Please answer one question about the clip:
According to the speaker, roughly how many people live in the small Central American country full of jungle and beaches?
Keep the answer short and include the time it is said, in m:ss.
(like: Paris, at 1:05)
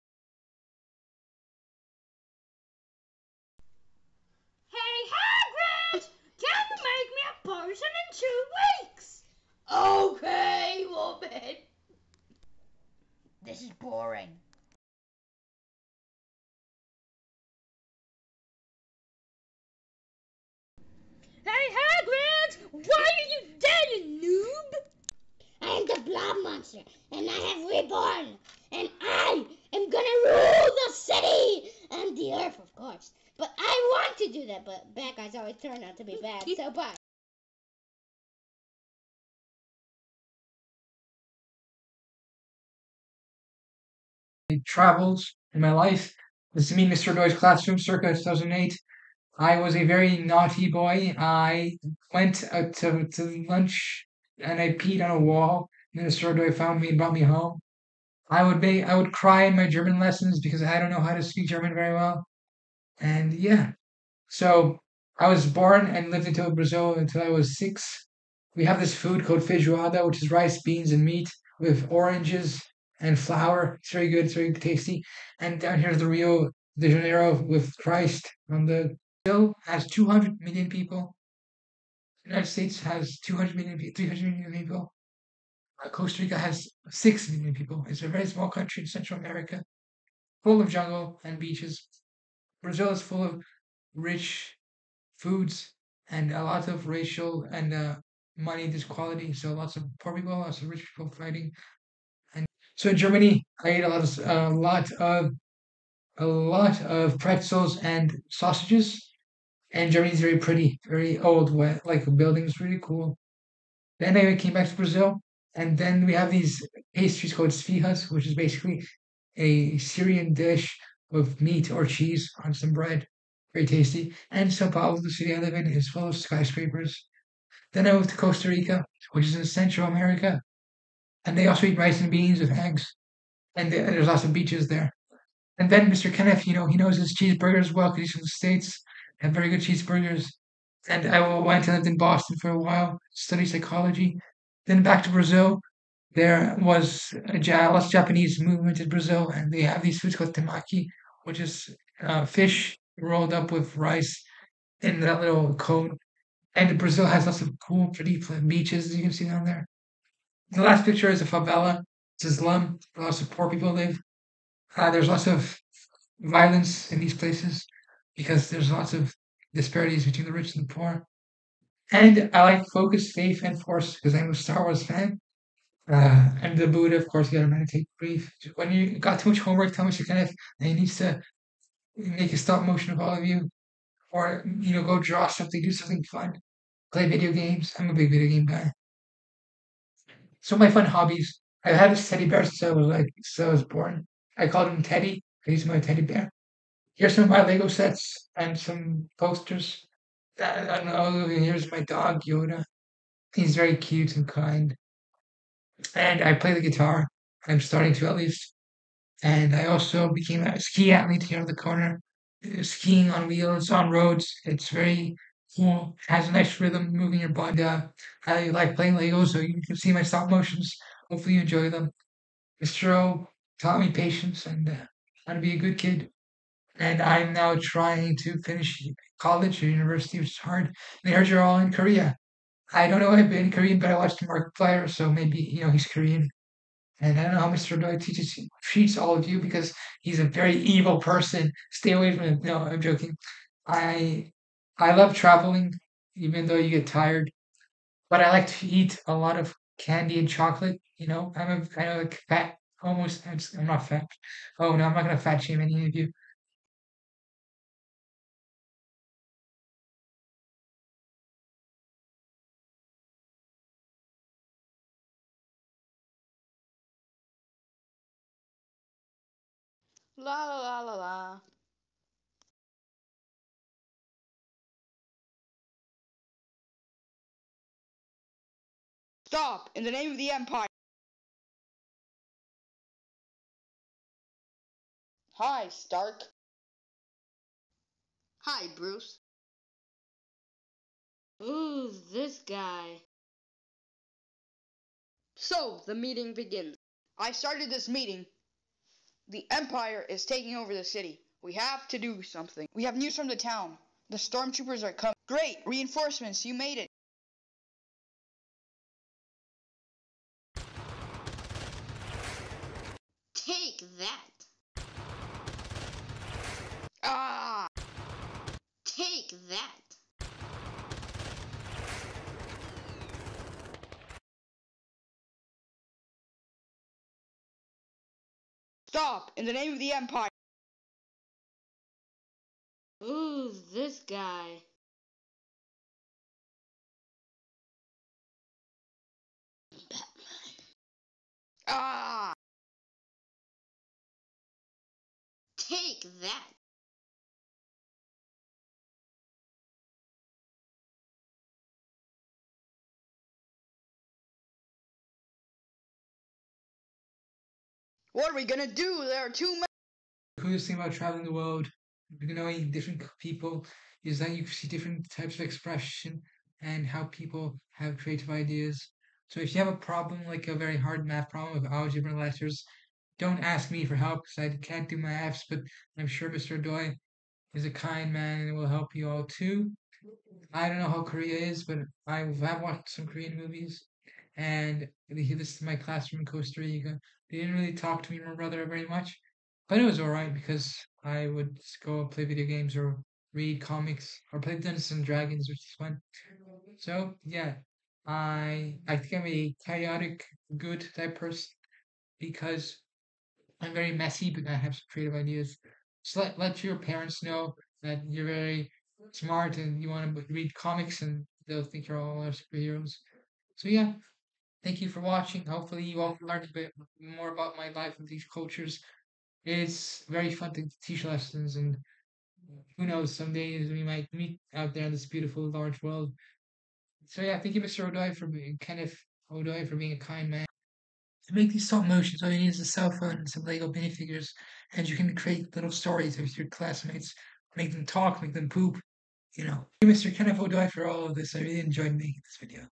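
6 million, at 1:26.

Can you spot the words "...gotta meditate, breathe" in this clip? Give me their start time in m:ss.
2:57.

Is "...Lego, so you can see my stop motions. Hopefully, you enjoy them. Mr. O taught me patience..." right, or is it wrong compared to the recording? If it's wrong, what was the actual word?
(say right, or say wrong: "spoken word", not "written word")
right.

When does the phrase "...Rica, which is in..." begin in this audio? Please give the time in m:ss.
2:08.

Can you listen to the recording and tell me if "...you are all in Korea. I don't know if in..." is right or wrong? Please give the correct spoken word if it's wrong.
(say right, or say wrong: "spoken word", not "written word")
right.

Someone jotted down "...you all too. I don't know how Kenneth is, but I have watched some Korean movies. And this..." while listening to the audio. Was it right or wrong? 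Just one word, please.
wrong.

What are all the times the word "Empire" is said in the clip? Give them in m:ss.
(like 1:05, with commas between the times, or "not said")
4:40, 4:59, 5:29.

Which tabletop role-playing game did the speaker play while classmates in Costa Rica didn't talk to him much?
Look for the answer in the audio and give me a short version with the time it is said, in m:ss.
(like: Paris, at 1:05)
Dungeons and Dragons, at 6:34.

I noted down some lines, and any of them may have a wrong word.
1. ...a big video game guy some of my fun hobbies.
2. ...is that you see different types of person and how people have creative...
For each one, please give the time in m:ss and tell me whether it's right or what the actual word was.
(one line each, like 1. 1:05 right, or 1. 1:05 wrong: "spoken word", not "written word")
1. 3:07 right
2. 6:04 wrong: "expression", not "person".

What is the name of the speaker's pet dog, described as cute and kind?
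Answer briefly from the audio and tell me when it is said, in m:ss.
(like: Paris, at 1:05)
Yoda, at 3:22.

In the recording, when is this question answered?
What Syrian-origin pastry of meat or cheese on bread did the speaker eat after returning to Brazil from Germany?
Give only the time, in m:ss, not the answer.
1:57.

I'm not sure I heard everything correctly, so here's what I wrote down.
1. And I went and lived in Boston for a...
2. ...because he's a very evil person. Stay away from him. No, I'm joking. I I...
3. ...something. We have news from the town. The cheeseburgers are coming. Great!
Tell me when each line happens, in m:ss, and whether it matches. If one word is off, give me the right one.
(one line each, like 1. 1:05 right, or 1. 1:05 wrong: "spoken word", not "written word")
1. 2:20 right
2. 3:59 right
3. 5:02 wrong: "stormtroopers", not "cheeseburgers".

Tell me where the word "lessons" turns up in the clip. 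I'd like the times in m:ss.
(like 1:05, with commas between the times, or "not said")
0:59, 7:01.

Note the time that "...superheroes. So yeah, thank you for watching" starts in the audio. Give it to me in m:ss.
6:52.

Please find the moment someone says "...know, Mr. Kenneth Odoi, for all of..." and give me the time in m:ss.
7:19.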